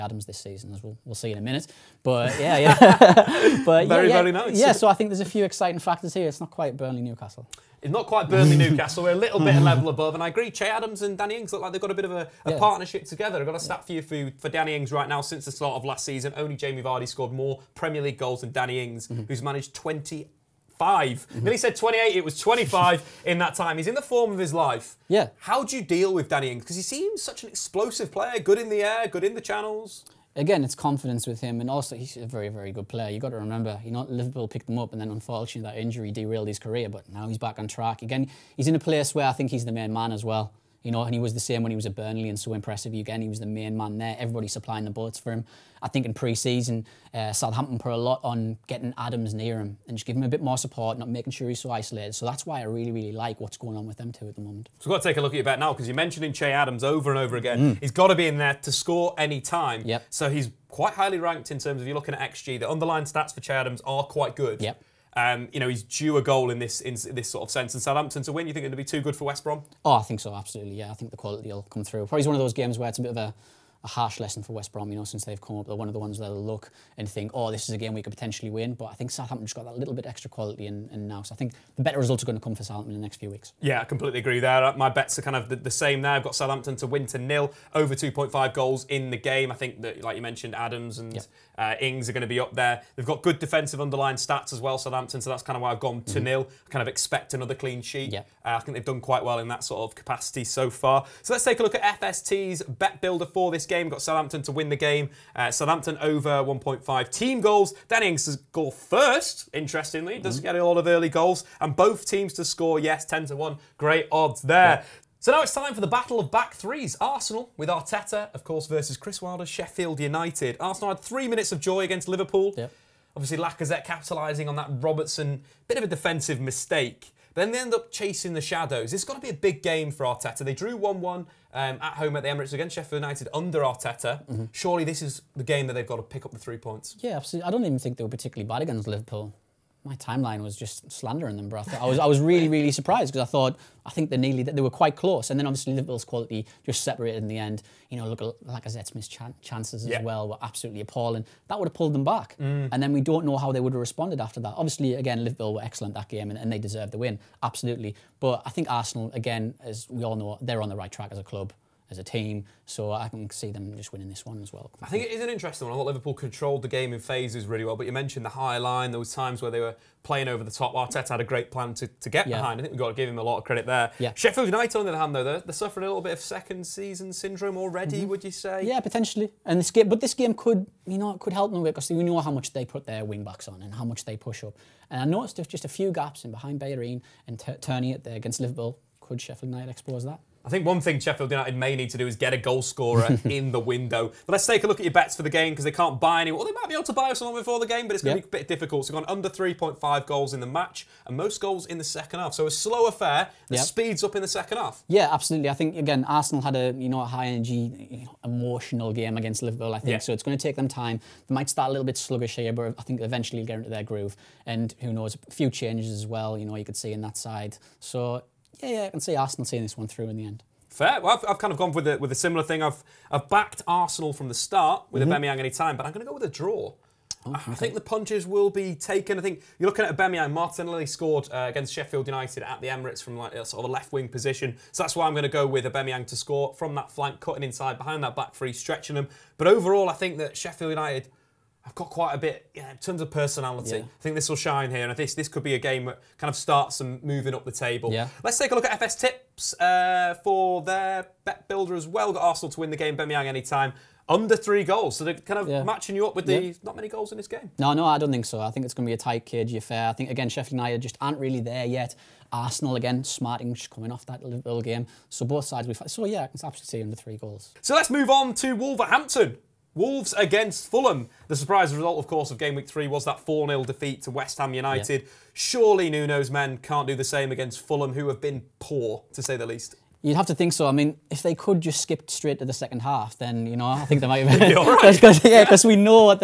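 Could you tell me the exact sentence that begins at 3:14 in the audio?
But let's take a look at your bets for the game because they can't buy anyone.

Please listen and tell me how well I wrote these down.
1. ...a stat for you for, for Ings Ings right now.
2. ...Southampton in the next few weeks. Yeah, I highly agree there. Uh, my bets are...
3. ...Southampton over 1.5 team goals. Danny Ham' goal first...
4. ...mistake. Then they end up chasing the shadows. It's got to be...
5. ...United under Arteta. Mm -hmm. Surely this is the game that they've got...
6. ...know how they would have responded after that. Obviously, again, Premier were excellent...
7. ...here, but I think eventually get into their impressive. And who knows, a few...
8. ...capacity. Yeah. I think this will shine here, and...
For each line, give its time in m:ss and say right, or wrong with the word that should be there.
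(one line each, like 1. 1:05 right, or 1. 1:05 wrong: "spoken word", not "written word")
1. 0:13 wrong: "Danny", not "Ings"
2. 1:22 wrong: "completely", not "highly"
3. 1:45 wrong: "Ings", not "Ham"
4. 2:06 right
5. 2:13 right
6. 2:33 wrong: "Liverpool", not "Premier"
7. 3:32 wrong: "groove", not "impressive"
8. 4:03 wrong: "personality", not "capacity".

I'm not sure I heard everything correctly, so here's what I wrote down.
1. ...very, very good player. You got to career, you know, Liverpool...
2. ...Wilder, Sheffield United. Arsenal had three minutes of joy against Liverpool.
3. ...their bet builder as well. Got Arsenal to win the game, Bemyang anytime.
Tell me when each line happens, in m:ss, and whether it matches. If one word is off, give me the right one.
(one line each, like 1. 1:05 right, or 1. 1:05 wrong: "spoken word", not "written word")
1. 0:32 wrong: "remember", not "career"
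2. 1:59 right
3. 4:10 right.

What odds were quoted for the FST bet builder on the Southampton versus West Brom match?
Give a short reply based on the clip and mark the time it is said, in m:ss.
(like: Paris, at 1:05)
10 to 1, at 1:53.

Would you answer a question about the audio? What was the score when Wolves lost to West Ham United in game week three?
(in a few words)
4-0.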